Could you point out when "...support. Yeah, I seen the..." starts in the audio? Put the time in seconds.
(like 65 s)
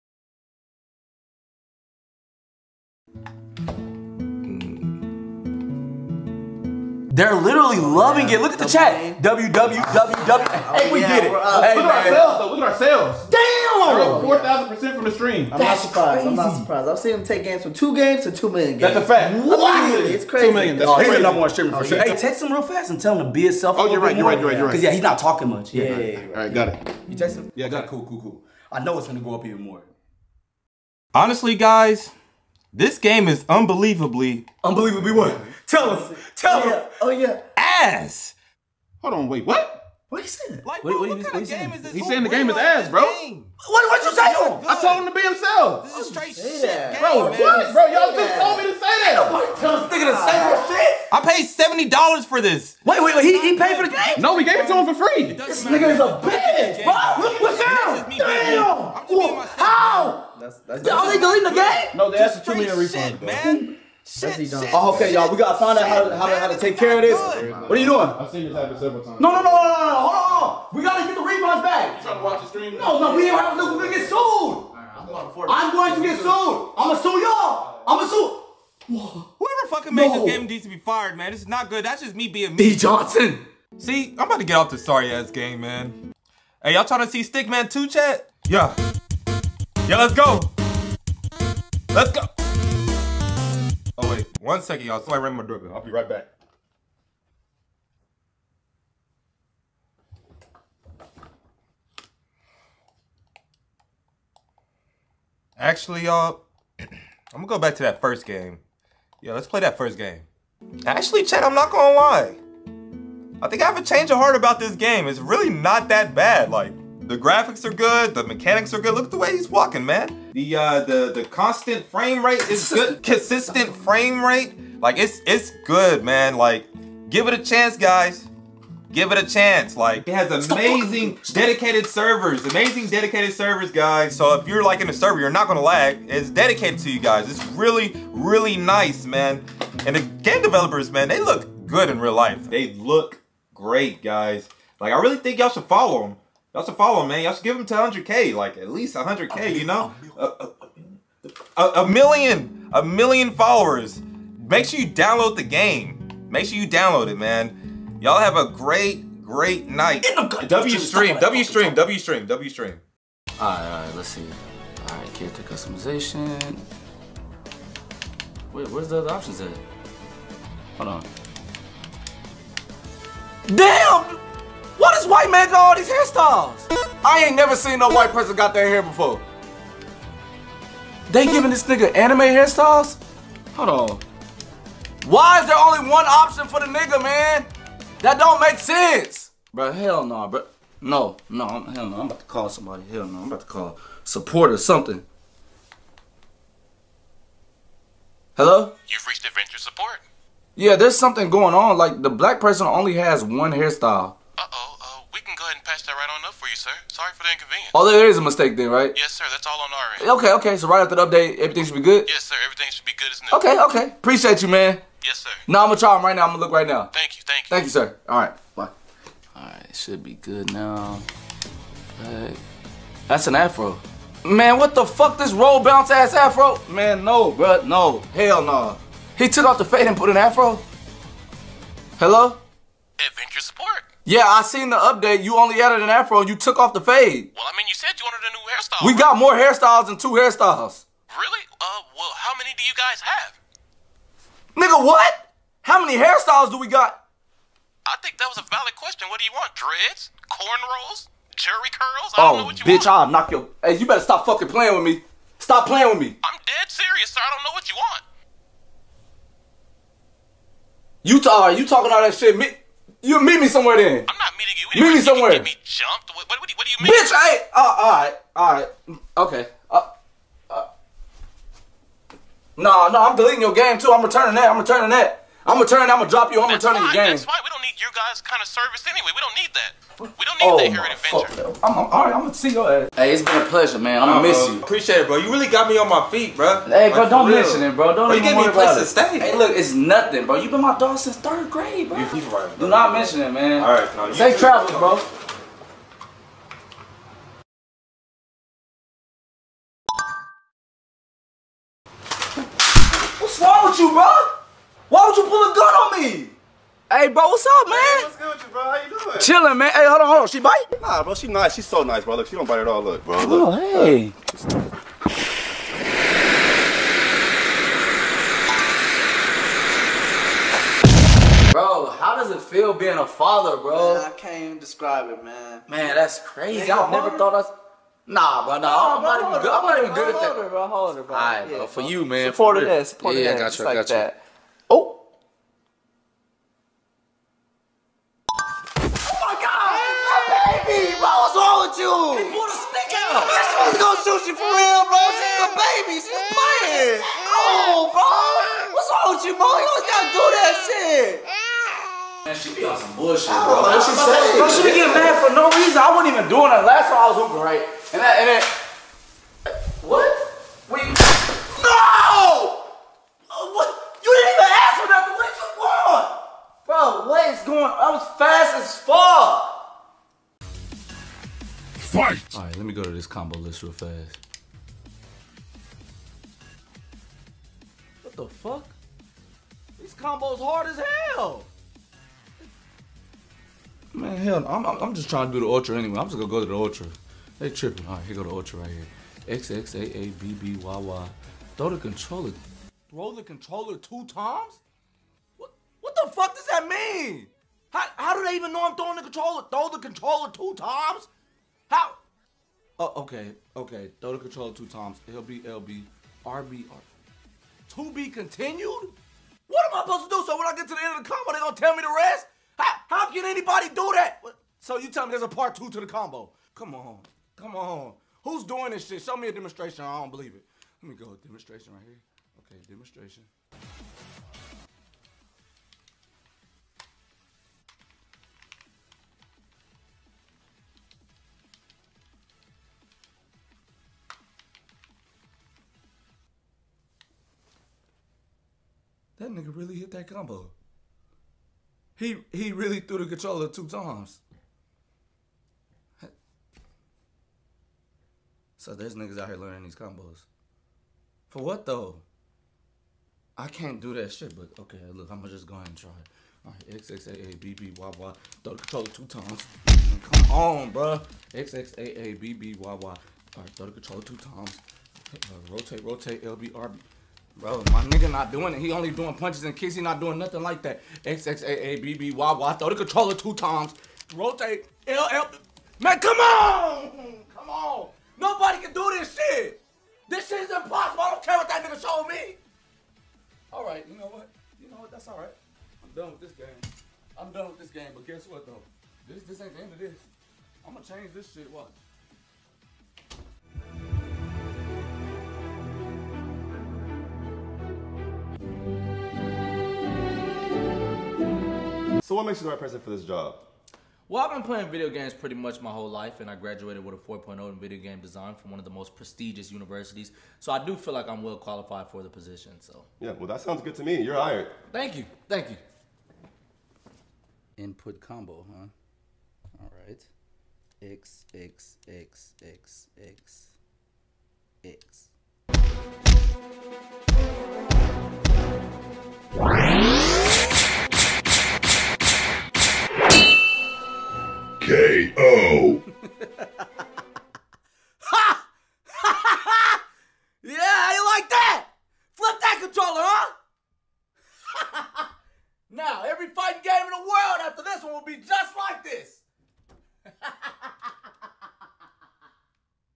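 233 s.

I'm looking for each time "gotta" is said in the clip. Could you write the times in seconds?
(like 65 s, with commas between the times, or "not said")
65 s, 70 s, 349 s.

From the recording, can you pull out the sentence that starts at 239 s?
got more hairstyles than two hairstyles.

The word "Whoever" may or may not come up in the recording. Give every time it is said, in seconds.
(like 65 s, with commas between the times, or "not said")
78 s.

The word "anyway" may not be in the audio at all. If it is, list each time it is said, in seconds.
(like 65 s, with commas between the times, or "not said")
278 s, 385 s.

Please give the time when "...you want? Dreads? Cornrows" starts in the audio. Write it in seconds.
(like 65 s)
249 s.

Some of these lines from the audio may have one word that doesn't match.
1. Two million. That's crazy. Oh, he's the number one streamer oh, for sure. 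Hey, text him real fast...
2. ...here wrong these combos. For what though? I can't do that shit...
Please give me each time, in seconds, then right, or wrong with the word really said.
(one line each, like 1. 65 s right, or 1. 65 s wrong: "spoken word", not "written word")
1. 20 s right
2. 449 s wrong: "learning", not "wrong".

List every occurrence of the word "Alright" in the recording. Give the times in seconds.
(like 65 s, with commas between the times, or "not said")
372 s, 456 s, 462 s.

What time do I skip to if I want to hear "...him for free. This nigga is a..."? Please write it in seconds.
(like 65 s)
54 s.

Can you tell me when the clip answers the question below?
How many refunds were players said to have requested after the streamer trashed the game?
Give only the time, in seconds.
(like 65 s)
62 s.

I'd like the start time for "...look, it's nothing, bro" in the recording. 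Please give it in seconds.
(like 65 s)
289 s.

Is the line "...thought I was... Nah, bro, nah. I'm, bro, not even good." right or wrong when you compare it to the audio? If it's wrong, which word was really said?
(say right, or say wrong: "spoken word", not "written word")
right.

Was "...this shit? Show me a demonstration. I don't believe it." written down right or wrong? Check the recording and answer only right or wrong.
right.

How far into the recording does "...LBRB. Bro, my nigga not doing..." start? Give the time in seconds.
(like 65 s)
466 s.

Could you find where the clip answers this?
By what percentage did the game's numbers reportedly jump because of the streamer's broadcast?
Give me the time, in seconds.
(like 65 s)
14 s.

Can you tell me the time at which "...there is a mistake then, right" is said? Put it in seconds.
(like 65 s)
207 s.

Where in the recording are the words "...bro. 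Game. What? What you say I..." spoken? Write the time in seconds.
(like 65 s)
42 s.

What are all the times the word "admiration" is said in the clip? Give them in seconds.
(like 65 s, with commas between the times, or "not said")
not said.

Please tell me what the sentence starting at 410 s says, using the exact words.
So when I get to the end of the combo, they gonna tell me the rest?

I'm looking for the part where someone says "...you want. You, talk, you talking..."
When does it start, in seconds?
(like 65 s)
257 s.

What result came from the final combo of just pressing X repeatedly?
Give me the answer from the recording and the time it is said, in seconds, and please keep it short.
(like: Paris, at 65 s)
TKO, at 534 s.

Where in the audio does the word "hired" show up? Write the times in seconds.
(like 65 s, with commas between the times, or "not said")
514 s.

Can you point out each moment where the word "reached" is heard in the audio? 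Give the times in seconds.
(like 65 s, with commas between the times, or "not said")
199 s.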